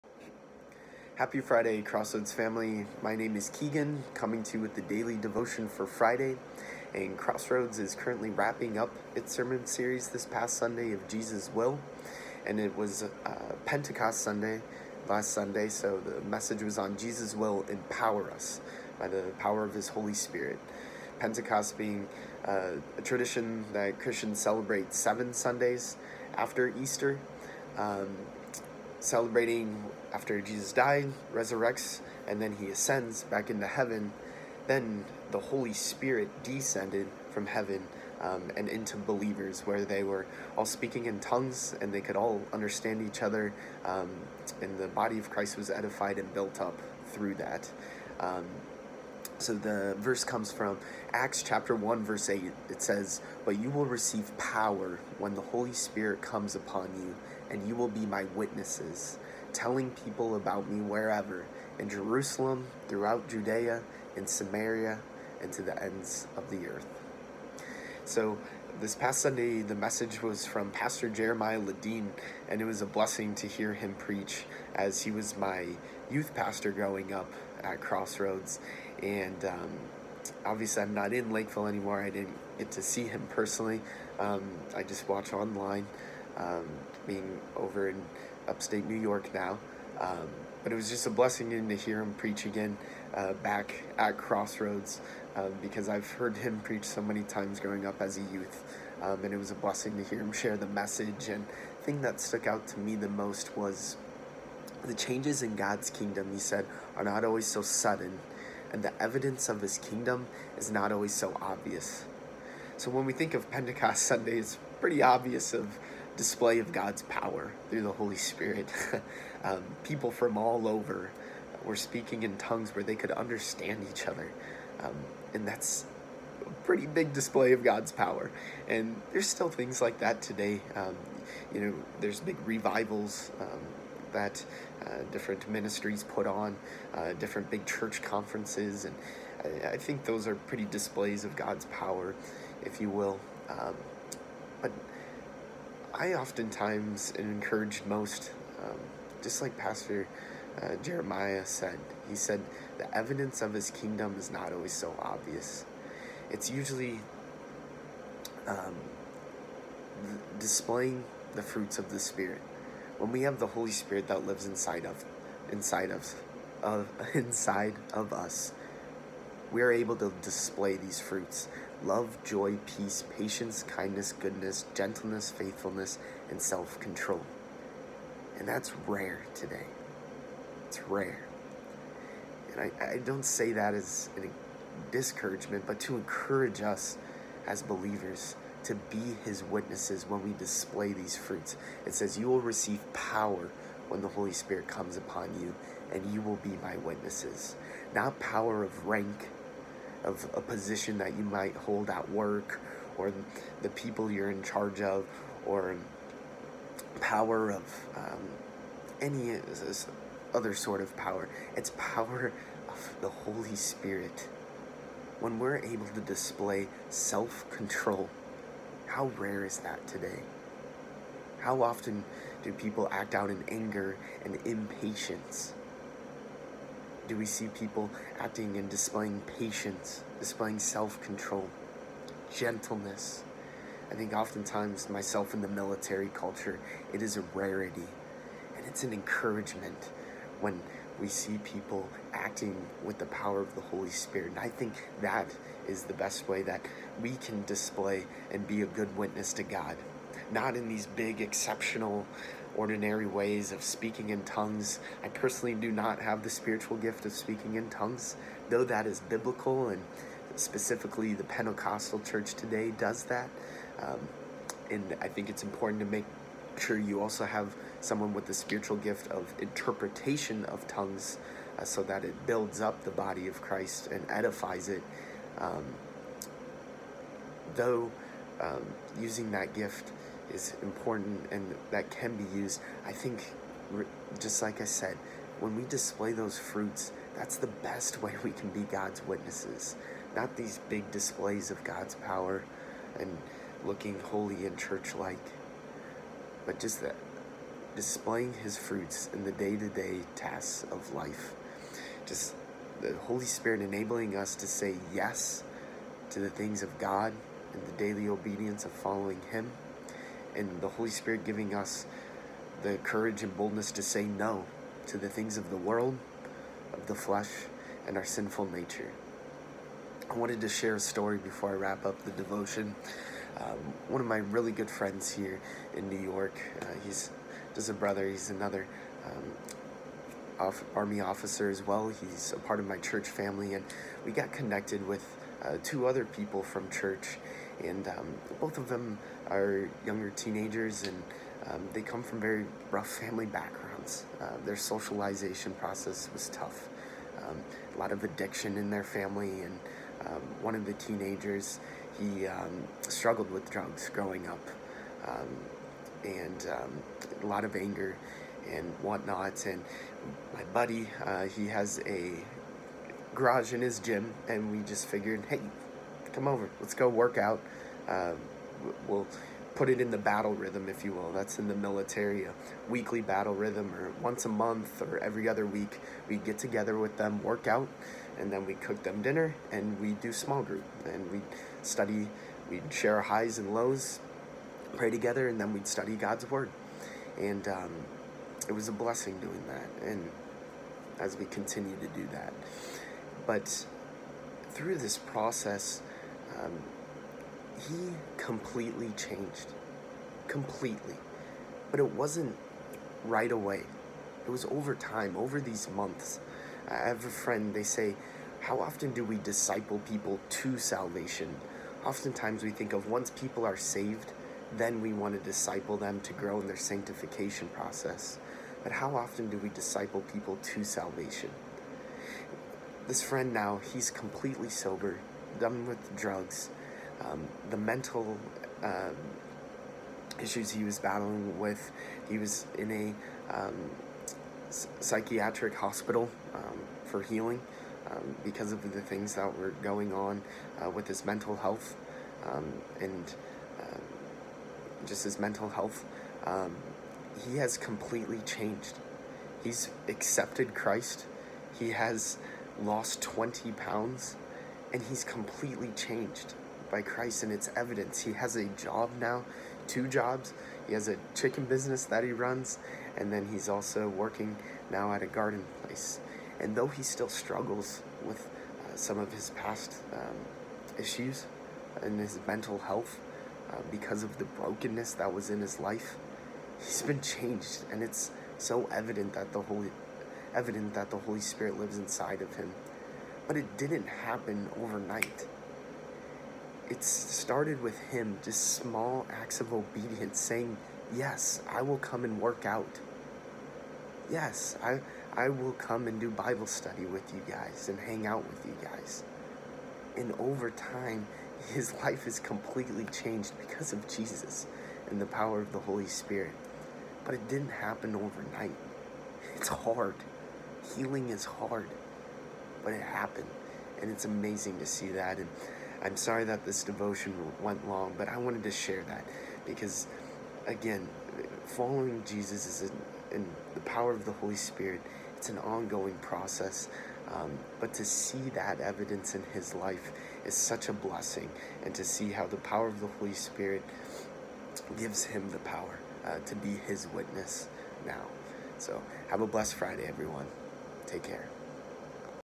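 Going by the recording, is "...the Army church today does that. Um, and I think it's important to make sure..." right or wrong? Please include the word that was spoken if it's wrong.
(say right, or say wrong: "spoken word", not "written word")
wrong: "Pentecostal", not "Army".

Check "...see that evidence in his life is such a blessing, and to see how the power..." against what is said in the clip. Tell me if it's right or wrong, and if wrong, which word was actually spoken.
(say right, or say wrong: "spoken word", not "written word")
right.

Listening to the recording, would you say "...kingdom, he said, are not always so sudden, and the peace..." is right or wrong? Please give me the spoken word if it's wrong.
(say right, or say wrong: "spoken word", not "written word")
wrong: "evidence", not "peace".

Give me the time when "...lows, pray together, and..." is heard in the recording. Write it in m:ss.
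6:23.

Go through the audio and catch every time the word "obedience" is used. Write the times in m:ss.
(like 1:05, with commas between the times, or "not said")
5:08, 8:09.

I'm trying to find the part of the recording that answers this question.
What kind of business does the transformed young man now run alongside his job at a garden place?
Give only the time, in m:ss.
7:41.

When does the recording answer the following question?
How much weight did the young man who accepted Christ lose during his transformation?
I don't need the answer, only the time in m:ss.
7:33.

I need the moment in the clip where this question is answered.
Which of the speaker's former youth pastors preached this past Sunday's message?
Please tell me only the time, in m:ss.
1:11.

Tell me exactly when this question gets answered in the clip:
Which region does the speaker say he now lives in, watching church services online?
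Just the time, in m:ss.
1:28.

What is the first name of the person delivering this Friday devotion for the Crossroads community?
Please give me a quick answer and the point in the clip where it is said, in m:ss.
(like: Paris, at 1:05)
Keegan, at 0:03.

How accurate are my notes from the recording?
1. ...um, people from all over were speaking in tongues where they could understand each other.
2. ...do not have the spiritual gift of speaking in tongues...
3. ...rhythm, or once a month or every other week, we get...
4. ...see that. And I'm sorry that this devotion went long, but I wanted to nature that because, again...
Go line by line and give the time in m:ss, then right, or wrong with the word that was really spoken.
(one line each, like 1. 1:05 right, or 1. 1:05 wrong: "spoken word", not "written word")
1. 1:59 right
2. 4:15 right
3. 6:13 right
4. 8:34 wrong: "share", not "nature".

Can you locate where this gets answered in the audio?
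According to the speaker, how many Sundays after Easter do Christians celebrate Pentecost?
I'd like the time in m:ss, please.
0:24.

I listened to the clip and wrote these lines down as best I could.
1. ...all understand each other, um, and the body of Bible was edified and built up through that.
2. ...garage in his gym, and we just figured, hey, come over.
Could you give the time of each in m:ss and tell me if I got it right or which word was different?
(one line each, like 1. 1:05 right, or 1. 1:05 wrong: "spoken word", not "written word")
1. 0:42 wrong: "Christ", not "Bible"
2. 6:03 right.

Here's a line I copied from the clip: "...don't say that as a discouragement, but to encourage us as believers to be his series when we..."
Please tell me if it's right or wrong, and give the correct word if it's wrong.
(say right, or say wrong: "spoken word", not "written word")
wrong: "witnesses", not "series".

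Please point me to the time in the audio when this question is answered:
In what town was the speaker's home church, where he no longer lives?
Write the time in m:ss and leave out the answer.
1:21.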